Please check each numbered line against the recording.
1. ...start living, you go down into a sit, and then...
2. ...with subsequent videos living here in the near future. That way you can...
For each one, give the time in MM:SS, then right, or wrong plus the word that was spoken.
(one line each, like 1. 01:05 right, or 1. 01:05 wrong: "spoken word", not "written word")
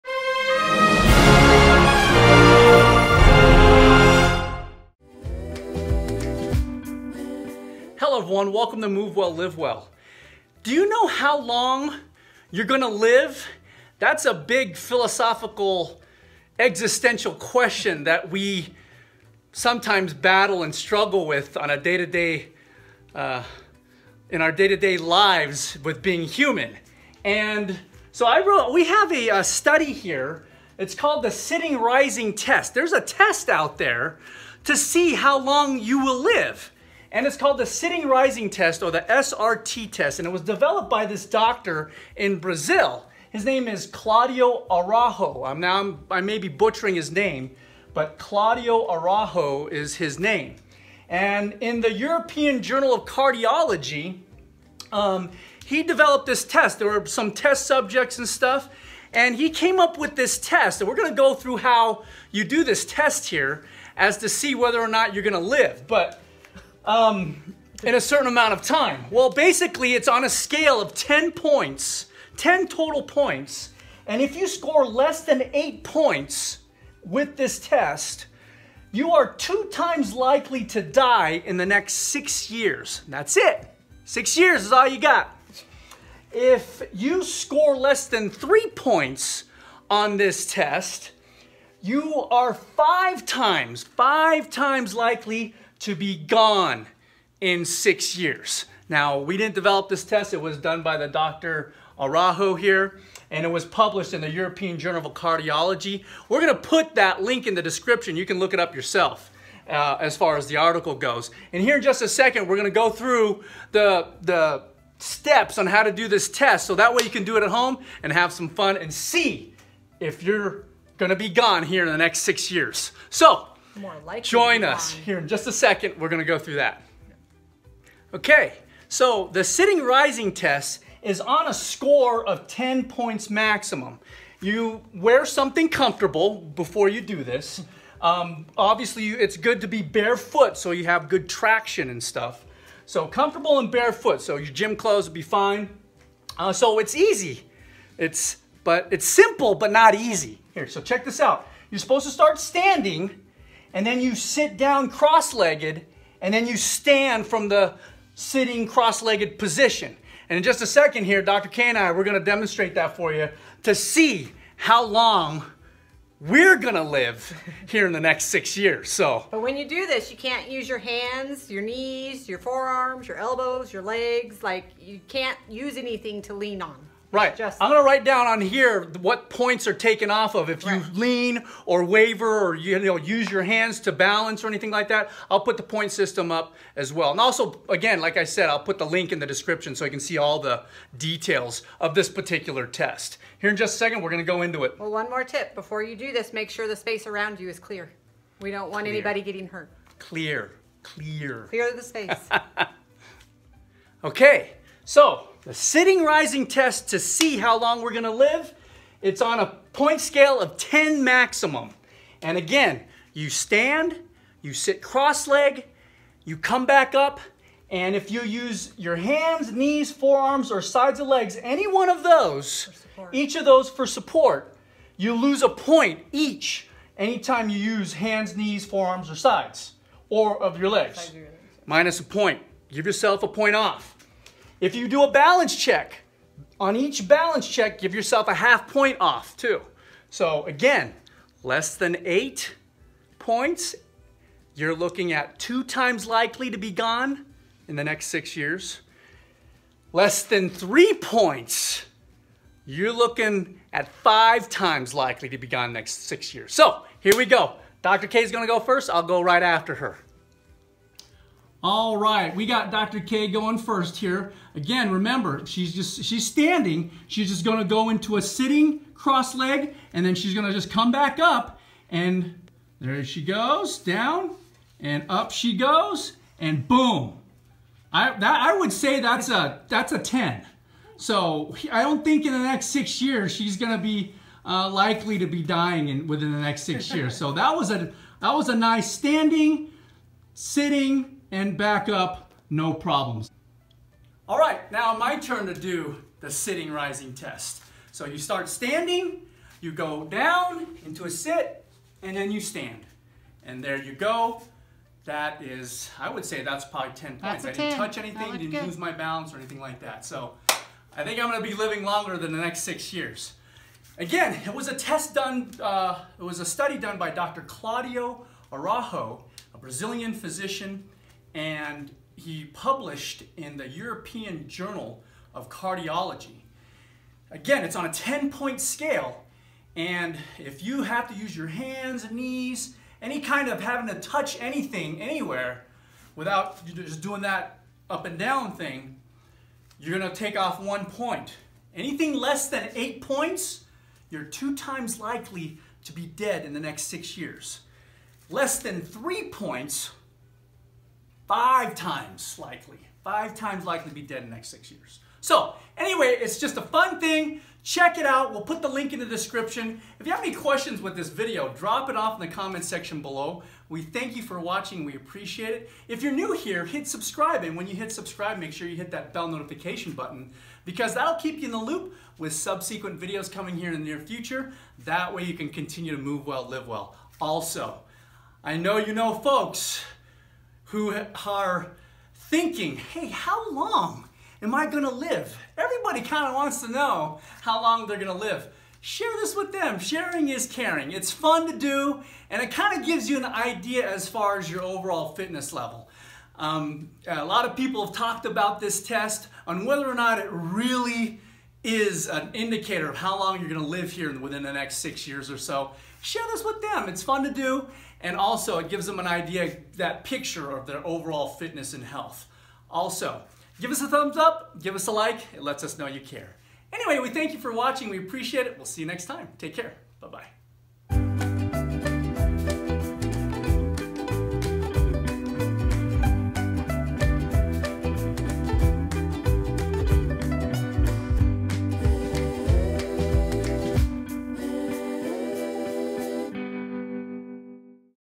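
1. 04:58 wrong: "standing", not "living"
2. 06:12 wrong: "coming", not "living".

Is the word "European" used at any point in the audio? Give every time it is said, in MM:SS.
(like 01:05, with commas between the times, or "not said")
00:51, 01:44, 05:23.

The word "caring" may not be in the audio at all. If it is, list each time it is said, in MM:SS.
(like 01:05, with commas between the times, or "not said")
06:30.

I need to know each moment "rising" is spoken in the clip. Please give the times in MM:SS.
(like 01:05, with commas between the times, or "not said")
00:31, 00:38, 02:09, 03:26, 04:56.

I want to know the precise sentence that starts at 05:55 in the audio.
So anyway, it's just a fun thing.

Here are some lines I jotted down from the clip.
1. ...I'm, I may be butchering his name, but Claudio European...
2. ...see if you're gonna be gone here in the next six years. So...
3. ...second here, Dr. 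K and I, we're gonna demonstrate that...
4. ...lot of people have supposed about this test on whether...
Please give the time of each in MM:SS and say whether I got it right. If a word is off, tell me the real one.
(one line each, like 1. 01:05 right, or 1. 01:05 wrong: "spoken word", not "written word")
1. 00:45 wrong: "Araujo", not "European"
2. 01:58 right
3. 02:40 right
4. 06:37 wrong: "talked", not "supposed".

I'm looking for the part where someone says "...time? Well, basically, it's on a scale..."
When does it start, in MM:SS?
01:08.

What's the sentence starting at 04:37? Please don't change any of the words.
I, that, I would say that's a, that's a 10.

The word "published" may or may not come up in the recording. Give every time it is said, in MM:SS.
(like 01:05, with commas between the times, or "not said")
01:43, 05:22.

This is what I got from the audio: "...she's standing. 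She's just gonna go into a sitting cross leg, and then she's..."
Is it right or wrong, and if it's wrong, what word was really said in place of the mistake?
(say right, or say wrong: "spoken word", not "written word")
right.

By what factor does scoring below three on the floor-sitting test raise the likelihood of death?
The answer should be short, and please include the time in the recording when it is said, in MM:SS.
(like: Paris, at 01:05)
5 times, at 01:32.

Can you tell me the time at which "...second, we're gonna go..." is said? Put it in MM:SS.
01:52.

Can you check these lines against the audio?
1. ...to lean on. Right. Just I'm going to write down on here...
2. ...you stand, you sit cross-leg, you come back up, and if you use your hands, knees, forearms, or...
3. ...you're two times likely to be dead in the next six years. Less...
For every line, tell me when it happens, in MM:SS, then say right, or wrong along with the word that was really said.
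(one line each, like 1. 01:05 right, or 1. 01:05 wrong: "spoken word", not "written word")
1. 02:56 right
2. 03:33 right
3. 05:44 right.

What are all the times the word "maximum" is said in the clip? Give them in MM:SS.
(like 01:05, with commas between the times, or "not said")
02:13, 03:31.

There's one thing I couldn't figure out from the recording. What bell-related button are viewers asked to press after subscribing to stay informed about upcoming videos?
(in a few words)
Bell notification button.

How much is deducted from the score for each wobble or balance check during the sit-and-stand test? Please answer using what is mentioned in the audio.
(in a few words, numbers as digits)
Half point.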